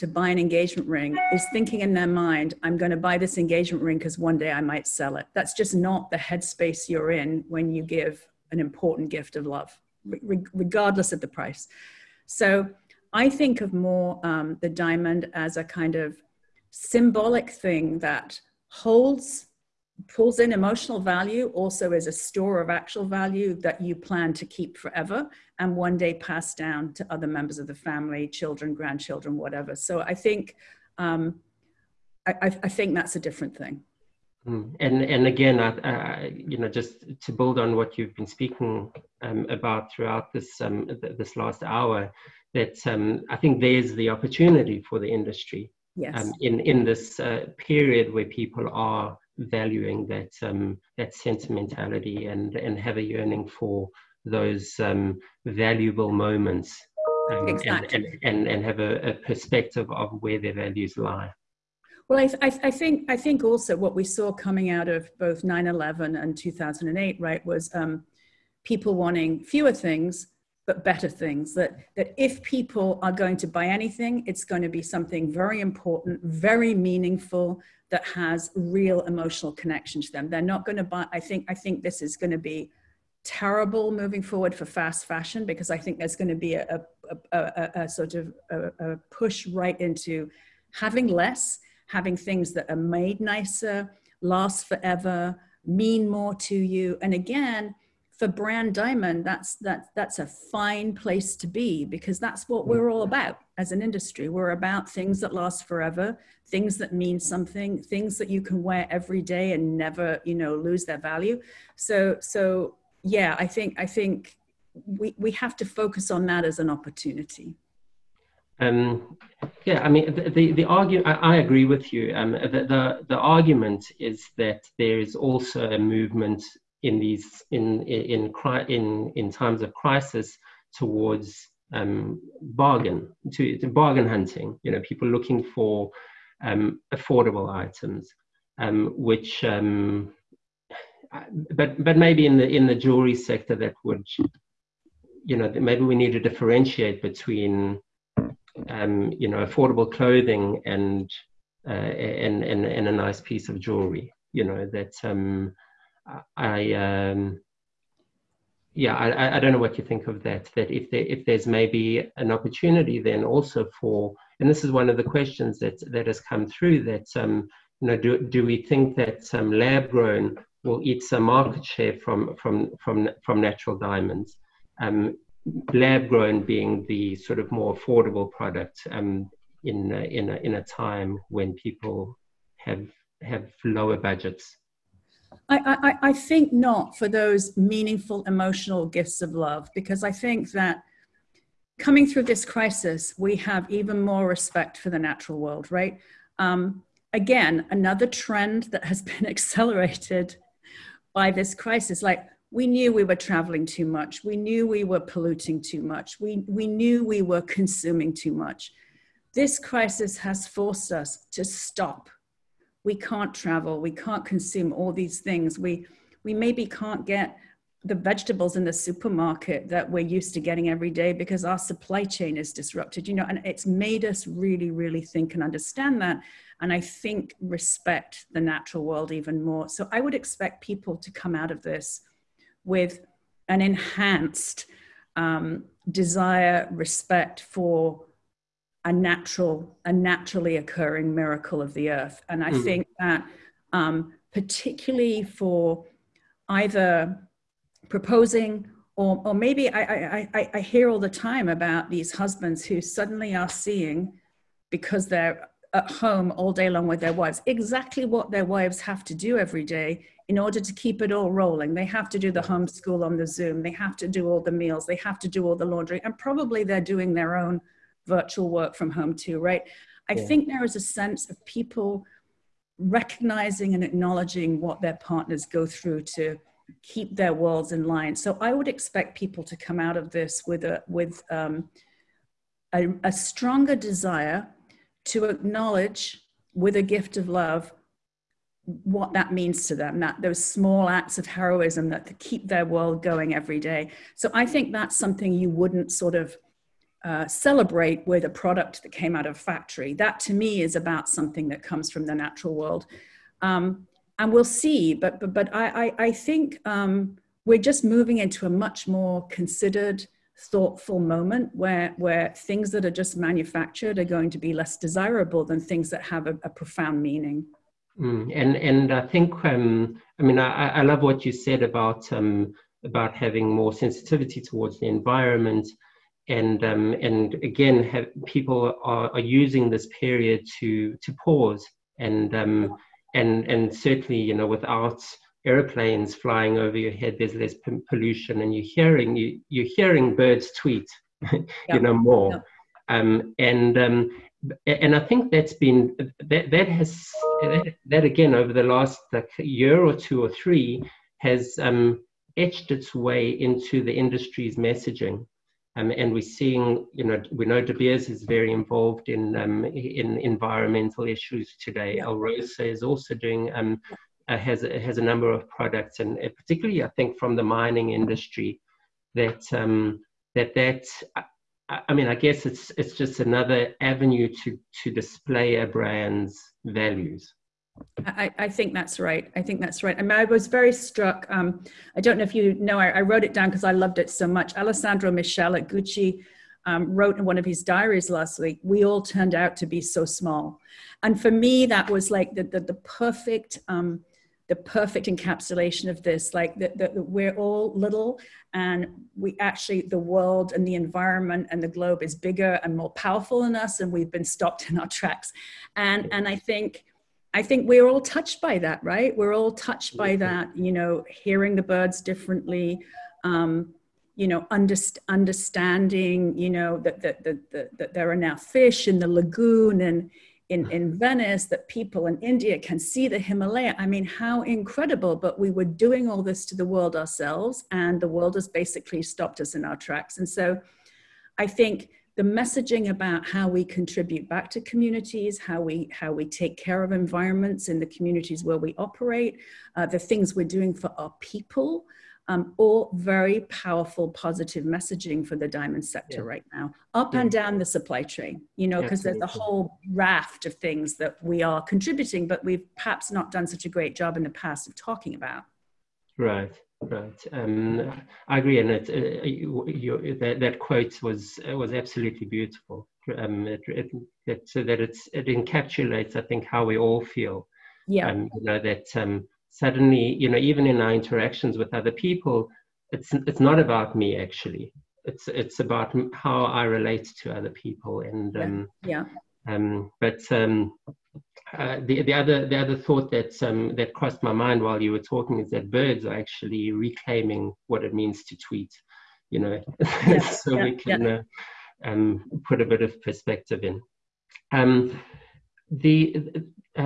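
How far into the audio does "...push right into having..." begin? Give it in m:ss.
1:29.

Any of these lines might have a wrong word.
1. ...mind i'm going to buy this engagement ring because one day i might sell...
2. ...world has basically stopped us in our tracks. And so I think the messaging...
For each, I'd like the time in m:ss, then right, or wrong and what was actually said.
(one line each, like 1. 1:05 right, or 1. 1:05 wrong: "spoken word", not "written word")
1. 0:02 right
2. 7:08 right.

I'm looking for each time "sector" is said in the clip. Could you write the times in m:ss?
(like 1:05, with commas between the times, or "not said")
2:23, 7:25.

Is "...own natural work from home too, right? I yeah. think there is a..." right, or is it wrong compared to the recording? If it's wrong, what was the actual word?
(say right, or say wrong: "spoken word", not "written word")
wrong: "virtual", not "natural".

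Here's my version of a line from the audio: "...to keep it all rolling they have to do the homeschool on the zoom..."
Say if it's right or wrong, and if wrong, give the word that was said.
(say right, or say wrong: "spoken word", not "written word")
right.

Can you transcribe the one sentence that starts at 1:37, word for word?
And again, for brand diamond that's that that's a fine place to be because that's what we're all mm.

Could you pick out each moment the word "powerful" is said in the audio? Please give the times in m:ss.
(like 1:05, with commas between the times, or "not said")
6:42, 7:23.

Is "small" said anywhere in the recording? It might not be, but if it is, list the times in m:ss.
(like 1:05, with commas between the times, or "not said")
4:50, 6:30.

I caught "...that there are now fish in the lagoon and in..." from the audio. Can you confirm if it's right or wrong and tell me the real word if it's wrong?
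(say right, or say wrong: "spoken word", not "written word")
right.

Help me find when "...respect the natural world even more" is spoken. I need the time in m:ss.
3:47.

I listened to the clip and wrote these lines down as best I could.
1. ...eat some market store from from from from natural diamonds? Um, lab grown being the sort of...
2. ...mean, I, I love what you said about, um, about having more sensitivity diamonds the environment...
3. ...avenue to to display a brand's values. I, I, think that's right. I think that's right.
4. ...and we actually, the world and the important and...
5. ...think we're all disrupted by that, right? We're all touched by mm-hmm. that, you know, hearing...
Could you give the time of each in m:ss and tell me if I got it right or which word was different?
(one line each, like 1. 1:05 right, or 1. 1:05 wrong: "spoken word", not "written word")
1. 2:50 wrong: "share", not "store"
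2. 5:20 wrong: "towards", not "diamonds"
3. 6:13 right
4. 6:38 wrong: "environment", not "important"
5. 6:47 wrong: "touched", not "disrupted".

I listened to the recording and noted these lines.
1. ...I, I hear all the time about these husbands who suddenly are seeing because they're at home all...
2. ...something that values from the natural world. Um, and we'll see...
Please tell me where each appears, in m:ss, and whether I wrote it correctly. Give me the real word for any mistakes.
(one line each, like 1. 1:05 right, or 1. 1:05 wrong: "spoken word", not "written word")
1. 4:10 right
2. 5:01 wrong: "comes", not "values".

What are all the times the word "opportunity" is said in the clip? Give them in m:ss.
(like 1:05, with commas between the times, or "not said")
0:44, 1:56, 2:42.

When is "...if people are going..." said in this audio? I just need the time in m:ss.
1:12.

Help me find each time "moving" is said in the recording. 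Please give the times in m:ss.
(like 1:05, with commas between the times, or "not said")
1:23, 5:07.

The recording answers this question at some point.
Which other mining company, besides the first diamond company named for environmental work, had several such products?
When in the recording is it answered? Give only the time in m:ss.
6:02.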